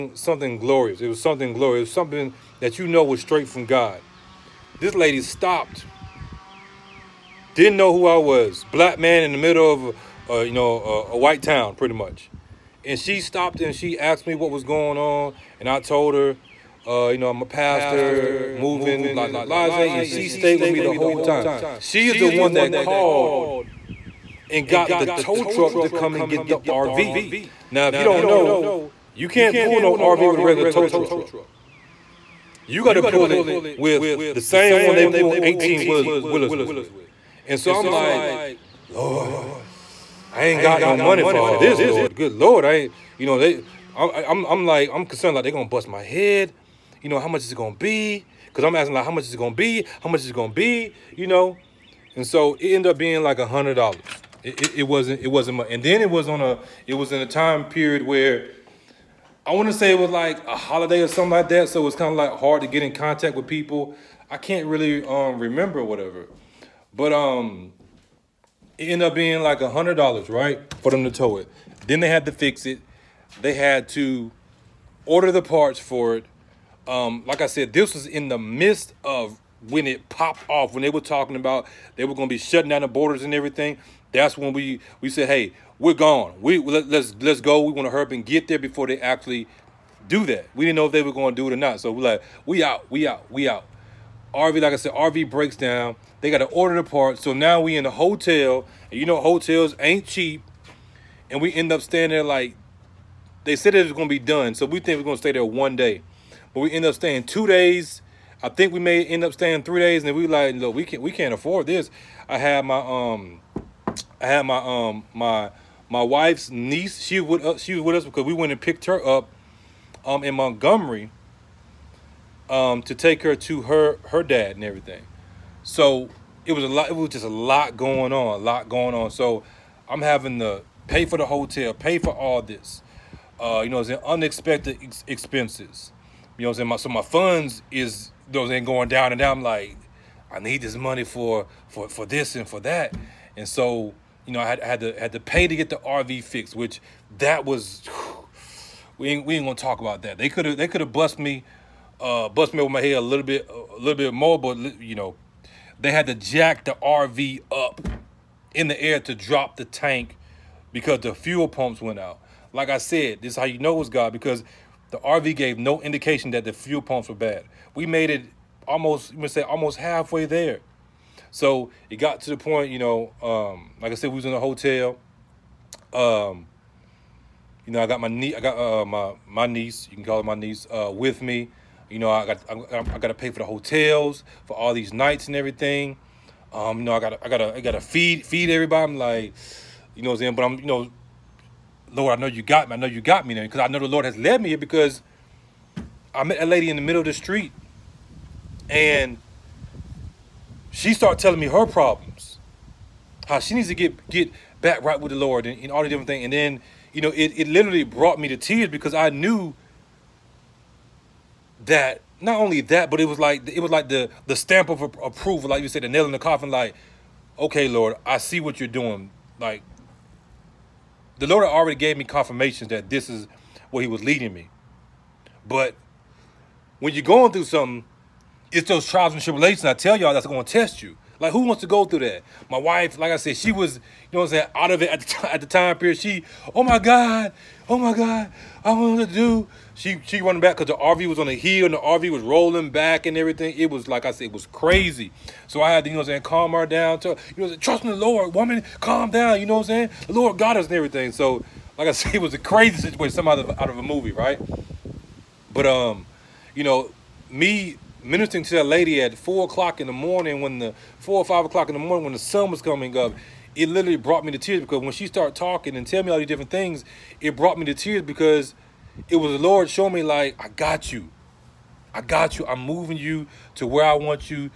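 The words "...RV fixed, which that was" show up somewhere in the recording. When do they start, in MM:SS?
02:25.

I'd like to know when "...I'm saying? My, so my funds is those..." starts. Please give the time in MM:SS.
02:16.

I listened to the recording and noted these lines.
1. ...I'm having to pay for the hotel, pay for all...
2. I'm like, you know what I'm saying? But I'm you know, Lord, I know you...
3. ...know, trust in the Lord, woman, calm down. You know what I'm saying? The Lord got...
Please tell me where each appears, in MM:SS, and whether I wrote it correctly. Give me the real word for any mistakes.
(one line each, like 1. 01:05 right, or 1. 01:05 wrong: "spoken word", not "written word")
1. 02:09 right
2. 03:08 right
3. 04:07 right.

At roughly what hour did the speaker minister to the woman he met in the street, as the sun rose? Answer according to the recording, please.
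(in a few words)
4 o'clock in the morning.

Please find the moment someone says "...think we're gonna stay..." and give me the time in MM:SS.
01:44.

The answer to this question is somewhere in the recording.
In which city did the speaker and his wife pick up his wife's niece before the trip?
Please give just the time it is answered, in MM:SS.
02:00.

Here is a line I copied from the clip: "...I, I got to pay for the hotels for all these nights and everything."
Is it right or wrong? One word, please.
right.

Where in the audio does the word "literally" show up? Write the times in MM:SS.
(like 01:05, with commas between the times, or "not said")
03:27, 04:23.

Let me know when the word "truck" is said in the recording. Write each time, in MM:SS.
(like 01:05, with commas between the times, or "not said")
00:25, 00:30.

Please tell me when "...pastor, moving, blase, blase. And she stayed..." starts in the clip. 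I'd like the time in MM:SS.
00:17.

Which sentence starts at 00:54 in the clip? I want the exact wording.
It, it, it, wasn't, it wasn't much.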